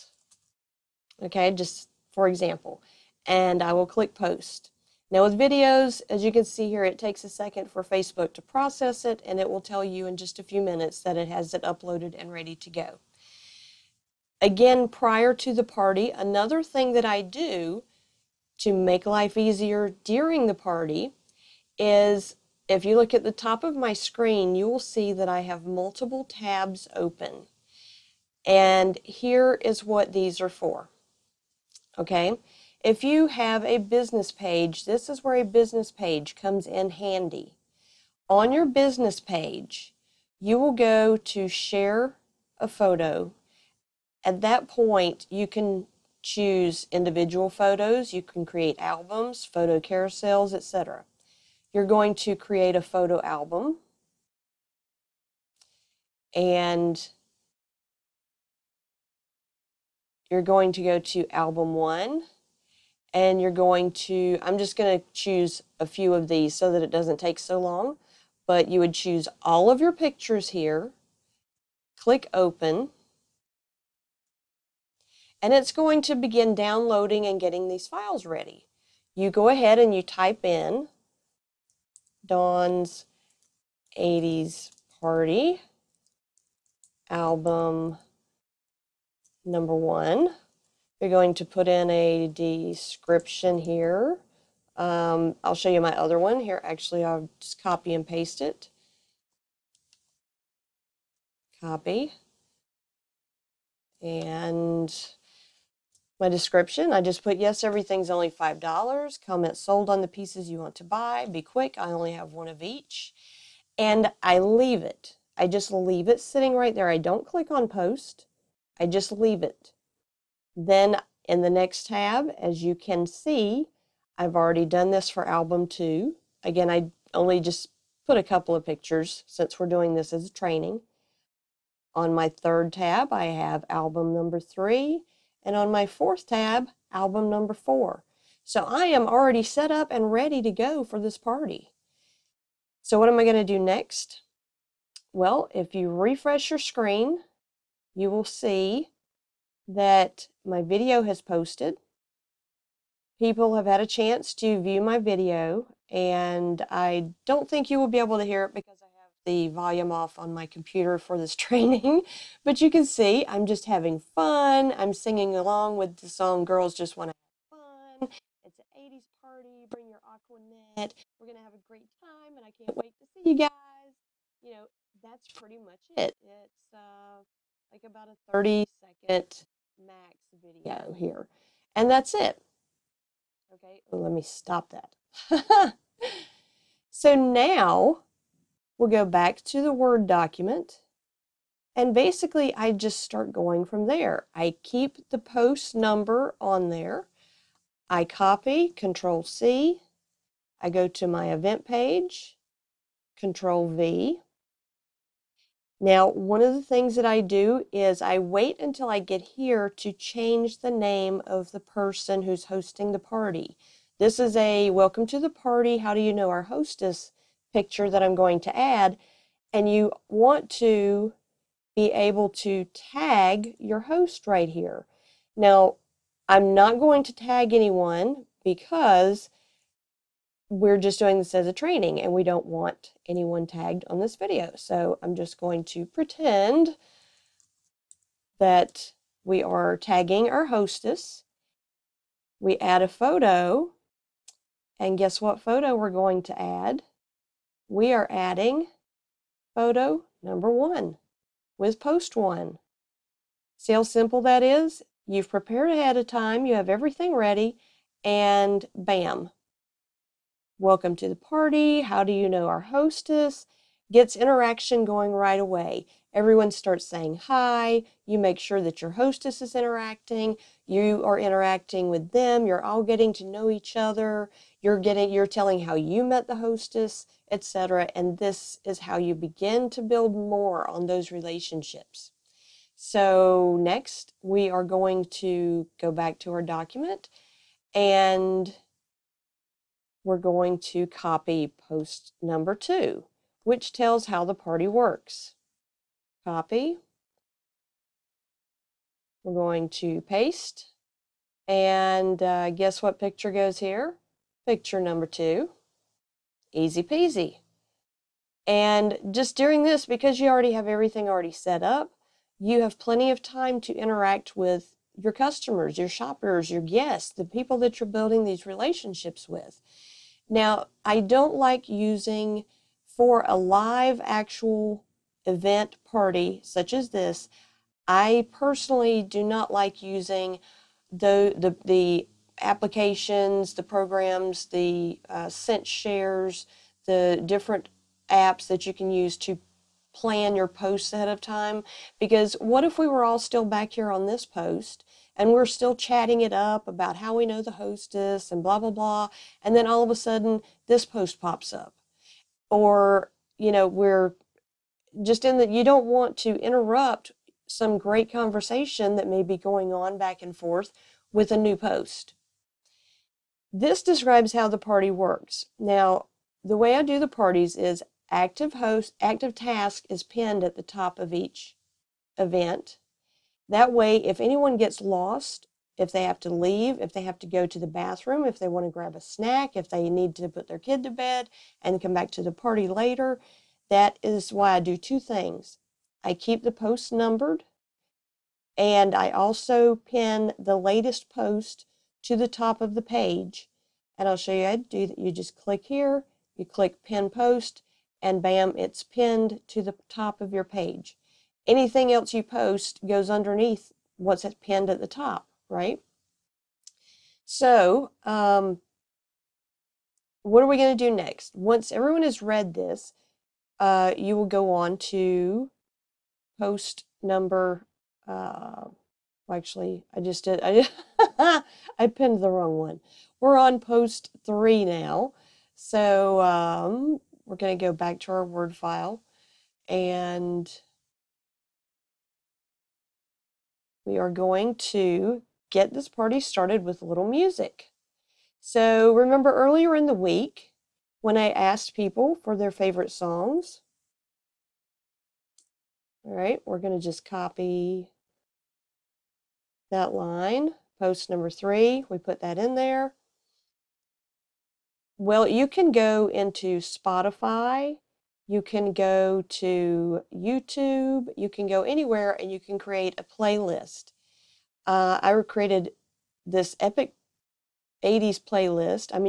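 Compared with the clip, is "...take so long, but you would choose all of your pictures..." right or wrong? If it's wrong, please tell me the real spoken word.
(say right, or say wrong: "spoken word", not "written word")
right.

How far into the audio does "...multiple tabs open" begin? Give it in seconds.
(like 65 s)
25 s.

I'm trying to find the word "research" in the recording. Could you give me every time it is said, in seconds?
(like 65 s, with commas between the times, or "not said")
not said.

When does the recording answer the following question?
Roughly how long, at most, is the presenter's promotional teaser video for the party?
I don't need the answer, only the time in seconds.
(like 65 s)
178 s.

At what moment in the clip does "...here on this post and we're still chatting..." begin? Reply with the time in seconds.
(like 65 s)
343 s.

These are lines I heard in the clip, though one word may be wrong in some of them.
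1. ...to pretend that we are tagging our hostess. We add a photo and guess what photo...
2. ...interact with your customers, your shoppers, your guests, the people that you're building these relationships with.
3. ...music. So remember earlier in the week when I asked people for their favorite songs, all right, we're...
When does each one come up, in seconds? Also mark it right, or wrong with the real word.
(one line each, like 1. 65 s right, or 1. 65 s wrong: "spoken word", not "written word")
1. 235 s right
2. 313 s right
3. 437 s right.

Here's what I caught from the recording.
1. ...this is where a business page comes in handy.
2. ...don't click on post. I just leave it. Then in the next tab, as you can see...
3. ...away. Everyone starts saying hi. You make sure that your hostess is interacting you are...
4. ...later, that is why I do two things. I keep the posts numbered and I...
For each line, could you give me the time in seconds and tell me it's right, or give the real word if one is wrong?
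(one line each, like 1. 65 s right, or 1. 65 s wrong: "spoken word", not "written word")
1. 34 s right
2. 116 s right
3. 265 s right
4. 382 s right.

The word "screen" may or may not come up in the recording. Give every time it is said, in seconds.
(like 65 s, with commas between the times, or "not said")
23 s, 146 s.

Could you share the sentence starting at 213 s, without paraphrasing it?
This is a welcome to the party.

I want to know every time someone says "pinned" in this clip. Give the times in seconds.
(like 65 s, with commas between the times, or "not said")
370 s, 398 s, 404 s, 421 s.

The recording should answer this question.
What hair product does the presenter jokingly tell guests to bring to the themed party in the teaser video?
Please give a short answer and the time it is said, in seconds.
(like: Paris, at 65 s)
Aquanet, at 169 s.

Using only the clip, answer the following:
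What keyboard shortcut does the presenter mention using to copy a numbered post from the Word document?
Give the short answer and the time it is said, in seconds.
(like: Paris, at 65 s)
Control C, at 198 s.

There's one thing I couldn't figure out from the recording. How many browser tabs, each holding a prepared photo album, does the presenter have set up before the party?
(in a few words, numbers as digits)
4.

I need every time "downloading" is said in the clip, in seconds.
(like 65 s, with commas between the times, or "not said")
76 s.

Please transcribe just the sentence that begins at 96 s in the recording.
Actually, I'll just copy and paste it.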